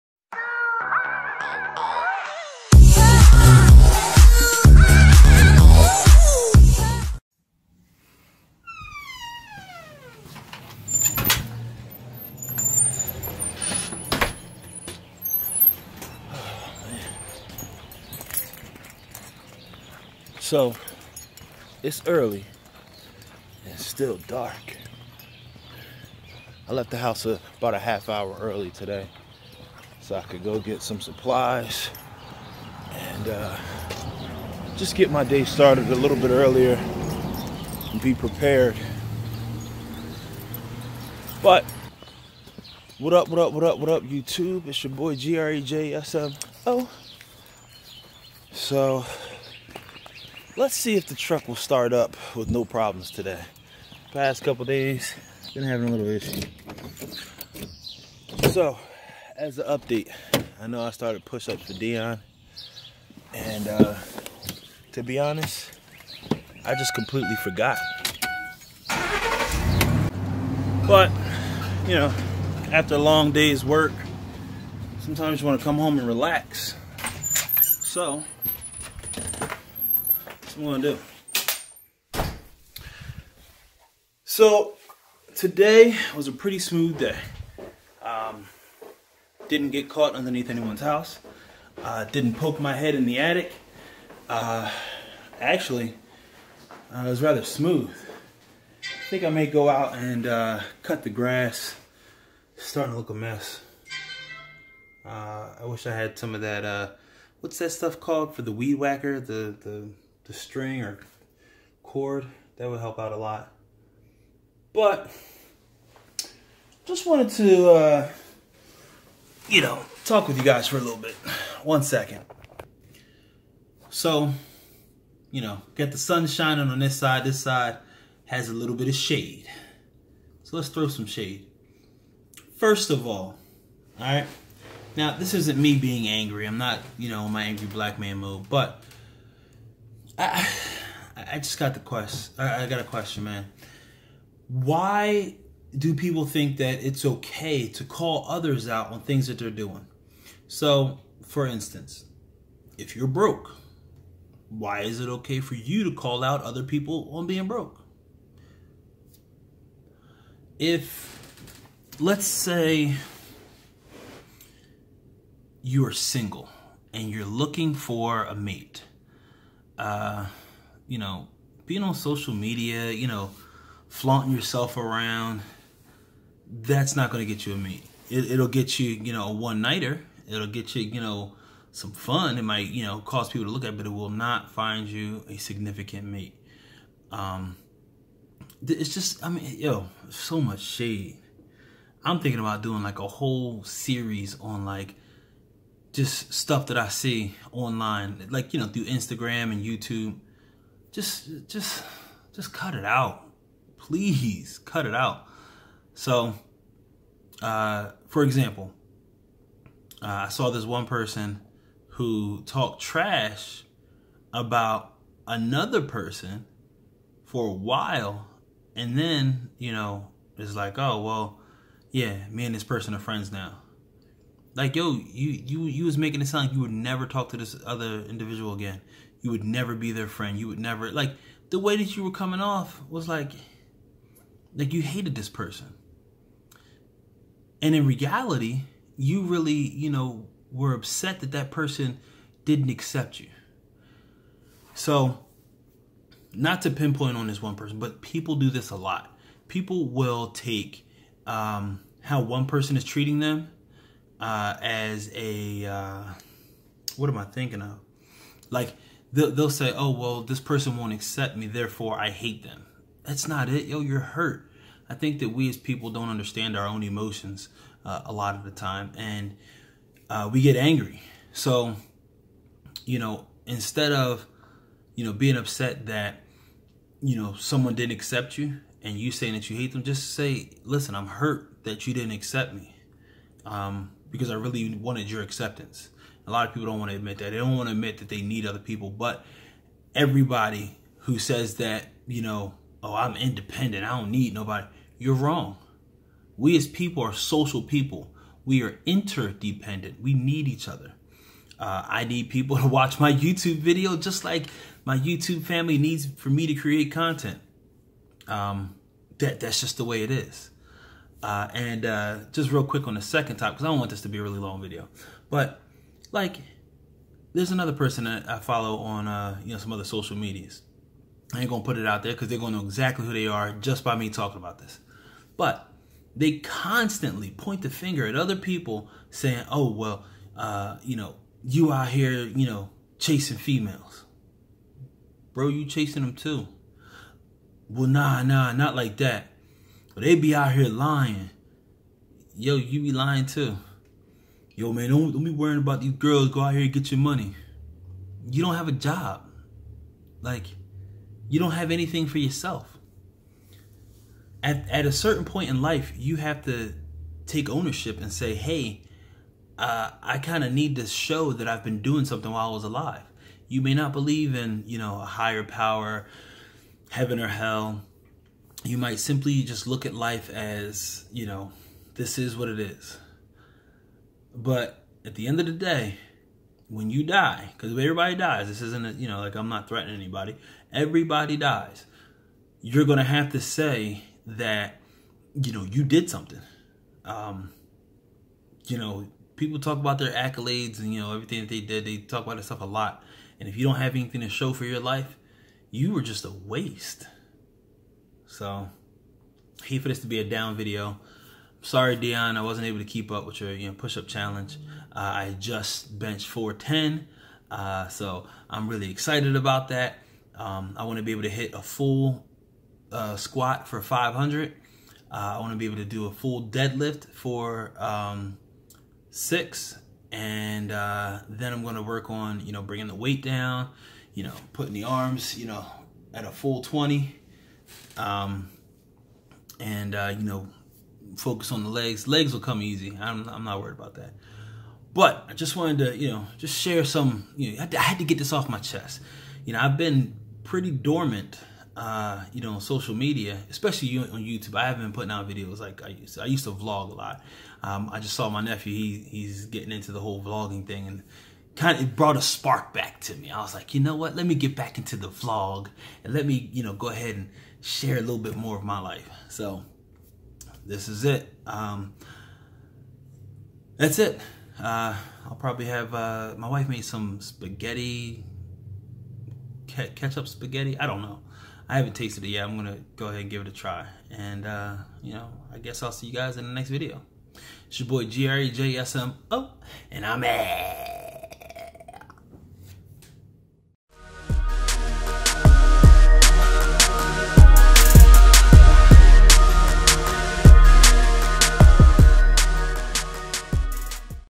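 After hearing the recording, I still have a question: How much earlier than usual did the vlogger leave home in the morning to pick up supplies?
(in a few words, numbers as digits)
half hour.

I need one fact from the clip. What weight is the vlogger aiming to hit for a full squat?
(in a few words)
500.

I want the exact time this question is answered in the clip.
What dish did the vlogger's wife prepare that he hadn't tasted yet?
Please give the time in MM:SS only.
07:49.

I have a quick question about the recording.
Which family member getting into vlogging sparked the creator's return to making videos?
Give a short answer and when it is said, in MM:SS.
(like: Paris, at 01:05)
nephew, at 07:28.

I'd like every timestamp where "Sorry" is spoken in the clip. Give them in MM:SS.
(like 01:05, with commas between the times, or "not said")
06:41.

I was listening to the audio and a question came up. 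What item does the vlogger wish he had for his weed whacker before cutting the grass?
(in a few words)
string.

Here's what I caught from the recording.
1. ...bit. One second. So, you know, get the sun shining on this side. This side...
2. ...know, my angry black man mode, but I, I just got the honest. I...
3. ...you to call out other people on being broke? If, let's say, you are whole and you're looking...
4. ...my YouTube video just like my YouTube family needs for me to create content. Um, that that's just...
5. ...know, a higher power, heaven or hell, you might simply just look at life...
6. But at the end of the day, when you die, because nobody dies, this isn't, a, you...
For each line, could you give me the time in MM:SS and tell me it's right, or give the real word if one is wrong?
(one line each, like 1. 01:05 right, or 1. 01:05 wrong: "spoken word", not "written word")
1. 02:00 right
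2. 02:17 wrong: "quest", not "honest"
3. 02:35 wrong: "single", not "whole"
4. 05:02 right
5. 06:04 right
6. 06:14 wrong: "everybody", not "nobody".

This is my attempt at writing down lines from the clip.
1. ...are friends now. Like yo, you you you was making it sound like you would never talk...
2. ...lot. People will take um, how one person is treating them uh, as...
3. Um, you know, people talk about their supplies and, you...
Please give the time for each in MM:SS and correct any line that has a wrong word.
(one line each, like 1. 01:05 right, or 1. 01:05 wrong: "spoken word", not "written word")
1. 03:42 right
2. 04:08 right
3. 06:27 wrong: "accolades", not "supplies".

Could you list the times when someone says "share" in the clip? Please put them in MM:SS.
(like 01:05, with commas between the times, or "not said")
07:16, 07:37.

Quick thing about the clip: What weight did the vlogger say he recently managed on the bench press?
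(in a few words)
410.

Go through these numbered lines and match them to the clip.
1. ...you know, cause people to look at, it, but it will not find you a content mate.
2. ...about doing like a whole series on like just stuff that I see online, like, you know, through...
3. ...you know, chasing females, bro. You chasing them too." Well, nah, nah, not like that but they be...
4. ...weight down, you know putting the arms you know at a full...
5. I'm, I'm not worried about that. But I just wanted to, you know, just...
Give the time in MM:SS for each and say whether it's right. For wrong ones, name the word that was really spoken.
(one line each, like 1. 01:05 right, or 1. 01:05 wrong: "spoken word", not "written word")
1. 03:02 wrong: "significant", not "content"
2. 03:12 right
3. 05:32 right
4. 07:02 right
5. 07:12 right.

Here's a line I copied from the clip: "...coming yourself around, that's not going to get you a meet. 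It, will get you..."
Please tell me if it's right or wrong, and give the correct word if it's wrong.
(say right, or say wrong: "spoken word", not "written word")
wrong: "flaunting", not "coming".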